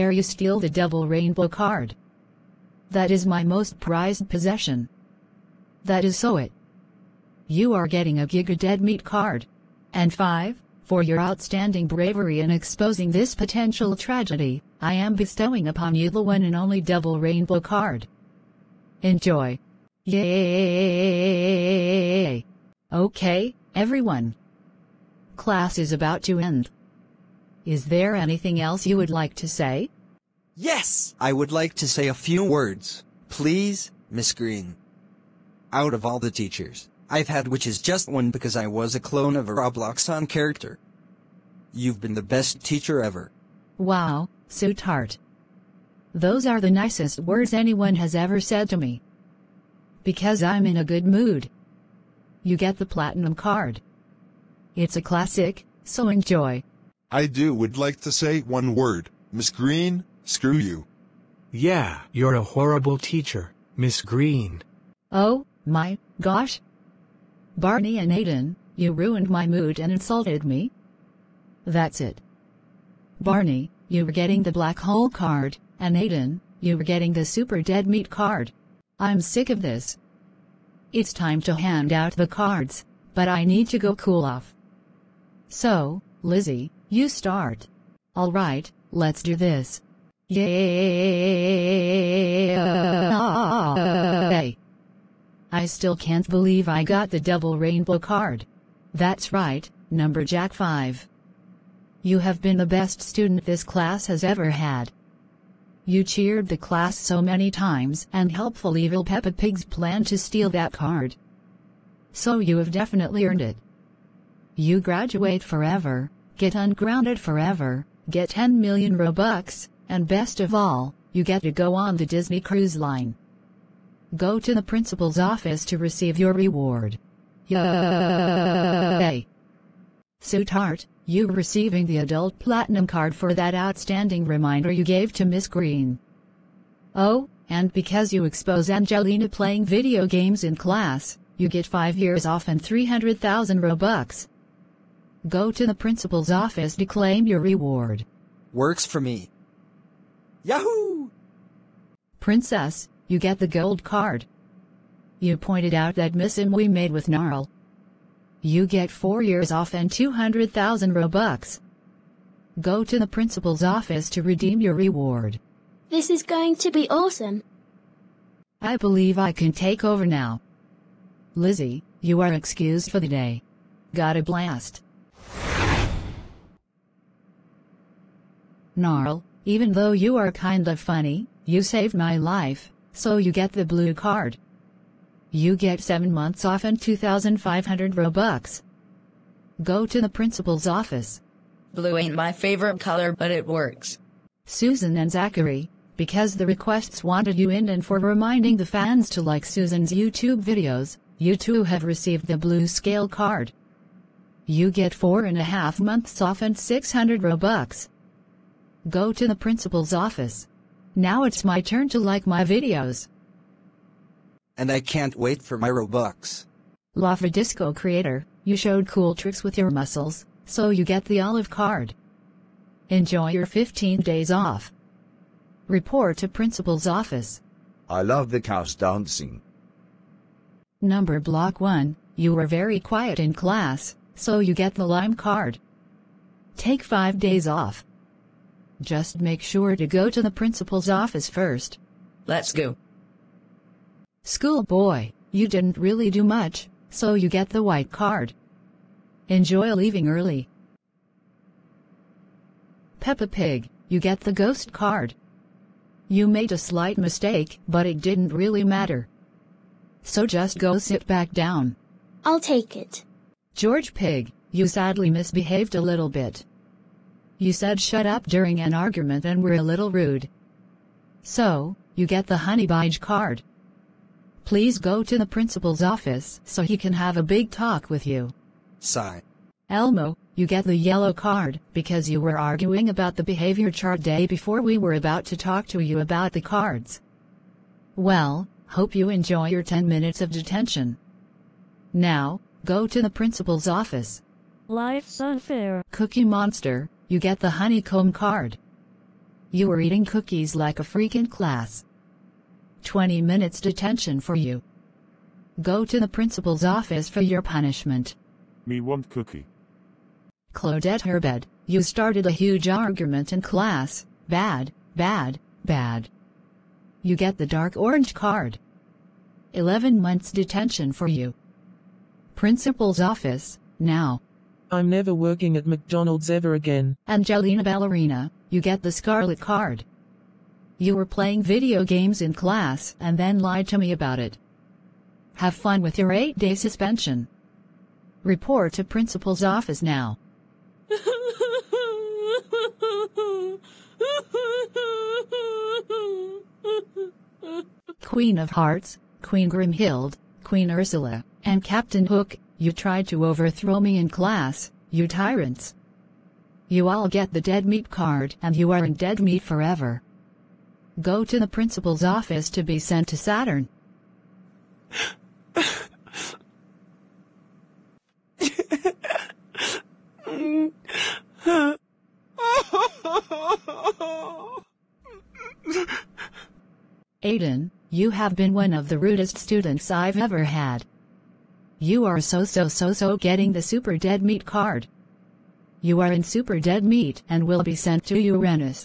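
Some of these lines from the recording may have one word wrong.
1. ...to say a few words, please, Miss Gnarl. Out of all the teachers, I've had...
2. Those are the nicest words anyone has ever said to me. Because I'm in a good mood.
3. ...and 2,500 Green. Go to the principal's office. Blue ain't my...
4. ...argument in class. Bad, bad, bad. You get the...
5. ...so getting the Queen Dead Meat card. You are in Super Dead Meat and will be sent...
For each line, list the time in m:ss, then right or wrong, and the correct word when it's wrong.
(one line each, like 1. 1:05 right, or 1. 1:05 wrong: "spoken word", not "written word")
1. 0:31 wrong: "Green", not "Gnarl"
2. 0:46 right
3. 3:06 wrong: "Robux", not "Green"
4. 5:12 right
5. 6:22 wrong: "Super", not "Queen".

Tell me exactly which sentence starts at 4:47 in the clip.
Well, hope you enjoy your 10 minutes of detention.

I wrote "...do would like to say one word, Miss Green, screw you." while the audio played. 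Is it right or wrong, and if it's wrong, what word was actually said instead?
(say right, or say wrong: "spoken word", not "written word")
right.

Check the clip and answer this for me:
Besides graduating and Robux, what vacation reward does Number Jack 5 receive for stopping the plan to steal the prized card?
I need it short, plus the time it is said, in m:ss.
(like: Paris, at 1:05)
Disney Cruise Line, at 2:02.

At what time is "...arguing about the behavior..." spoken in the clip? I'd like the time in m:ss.
4:42.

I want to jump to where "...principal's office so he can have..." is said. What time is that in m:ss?
4:35.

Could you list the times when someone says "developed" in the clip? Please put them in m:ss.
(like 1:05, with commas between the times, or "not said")
not said.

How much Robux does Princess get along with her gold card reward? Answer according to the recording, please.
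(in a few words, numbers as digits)
200,000.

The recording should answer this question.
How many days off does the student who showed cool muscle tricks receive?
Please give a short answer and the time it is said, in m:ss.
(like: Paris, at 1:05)
15, at 3:43.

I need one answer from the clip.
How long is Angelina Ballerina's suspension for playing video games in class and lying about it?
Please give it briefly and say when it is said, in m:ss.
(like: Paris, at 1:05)
8 days, at 5:36.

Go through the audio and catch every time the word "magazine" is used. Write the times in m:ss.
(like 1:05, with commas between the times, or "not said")
not said.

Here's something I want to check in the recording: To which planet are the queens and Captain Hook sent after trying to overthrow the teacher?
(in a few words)
Saturn.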